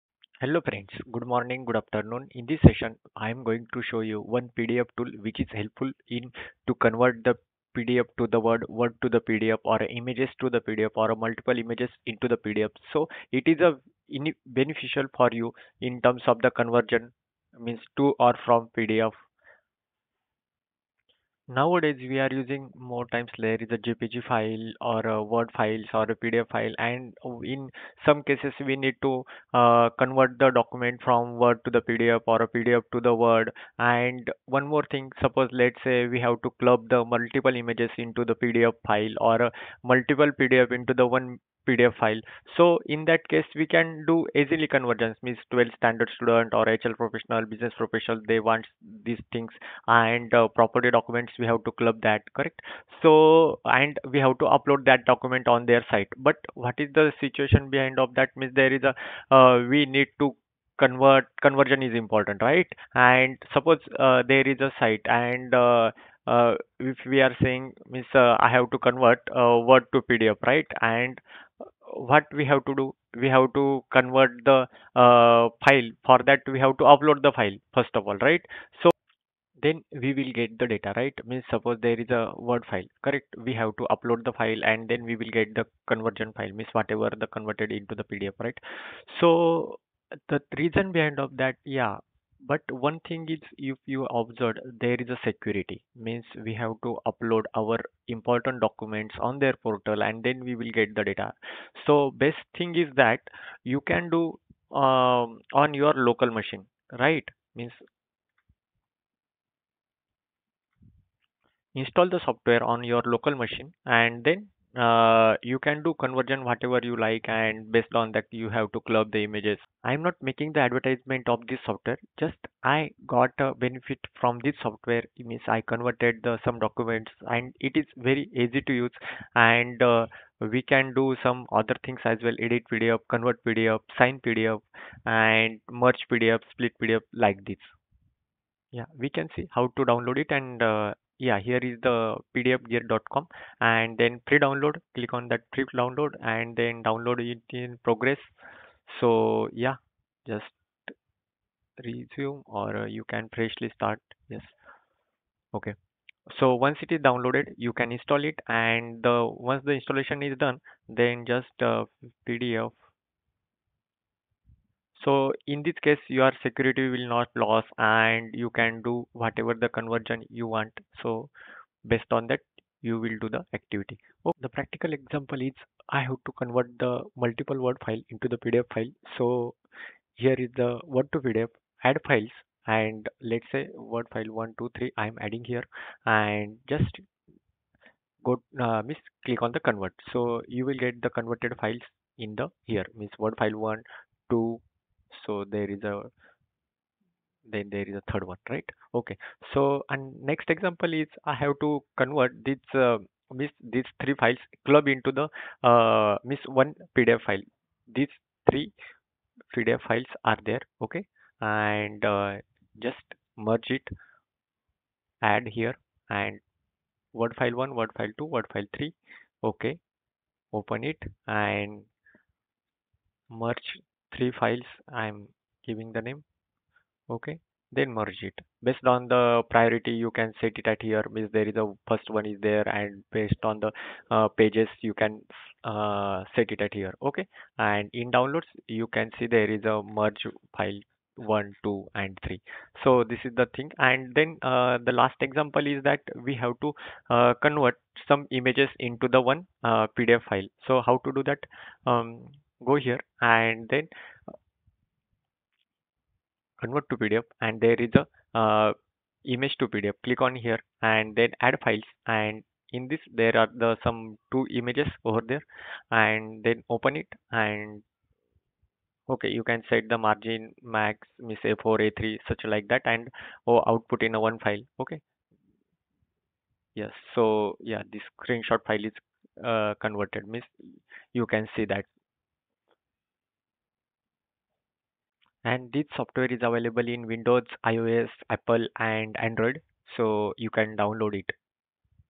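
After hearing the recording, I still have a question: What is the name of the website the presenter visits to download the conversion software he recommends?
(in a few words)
pdfgear.com.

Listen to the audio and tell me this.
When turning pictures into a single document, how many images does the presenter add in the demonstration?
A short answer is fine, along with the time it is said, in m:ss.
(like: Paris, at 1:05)
2, at 4:23.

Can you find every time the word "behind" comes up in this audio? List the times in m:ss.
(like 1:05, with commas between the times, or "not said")
0:57, 1:30.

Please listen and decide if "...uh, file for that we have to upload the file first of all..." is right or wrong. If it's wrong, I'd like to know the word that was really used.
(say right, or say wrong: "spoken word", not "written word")
right.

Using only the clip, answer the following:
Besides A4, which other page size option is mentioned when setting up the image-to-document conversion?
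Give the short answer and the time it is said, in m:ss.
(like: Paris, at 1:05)
A3, at 4:31.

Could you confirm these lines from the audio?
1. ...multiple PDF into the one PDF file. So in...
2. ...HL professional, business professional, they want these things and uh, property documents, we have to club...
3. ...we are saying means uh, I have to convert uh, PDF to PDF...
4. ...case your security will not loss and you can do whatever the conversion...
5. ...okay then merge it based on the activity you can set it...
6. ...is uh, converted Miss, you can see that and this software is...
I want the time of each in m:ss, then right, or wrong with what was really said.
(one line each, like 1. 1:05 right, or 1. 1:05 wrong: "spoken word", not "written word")
1. 0:39 right
2. 0:46 right
3. 1:07 wrong: "Word", not "PDF"
4. 2:45 right
5. 3:47 wrong: "priority", not "activity"
6. 4:38 right.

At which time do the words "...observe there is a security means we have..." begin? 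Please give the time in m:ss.
1:34.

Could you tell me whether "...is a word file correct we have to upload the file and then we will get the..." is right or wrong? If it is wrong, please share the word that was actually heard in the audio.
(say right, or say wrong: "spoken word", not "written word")
right.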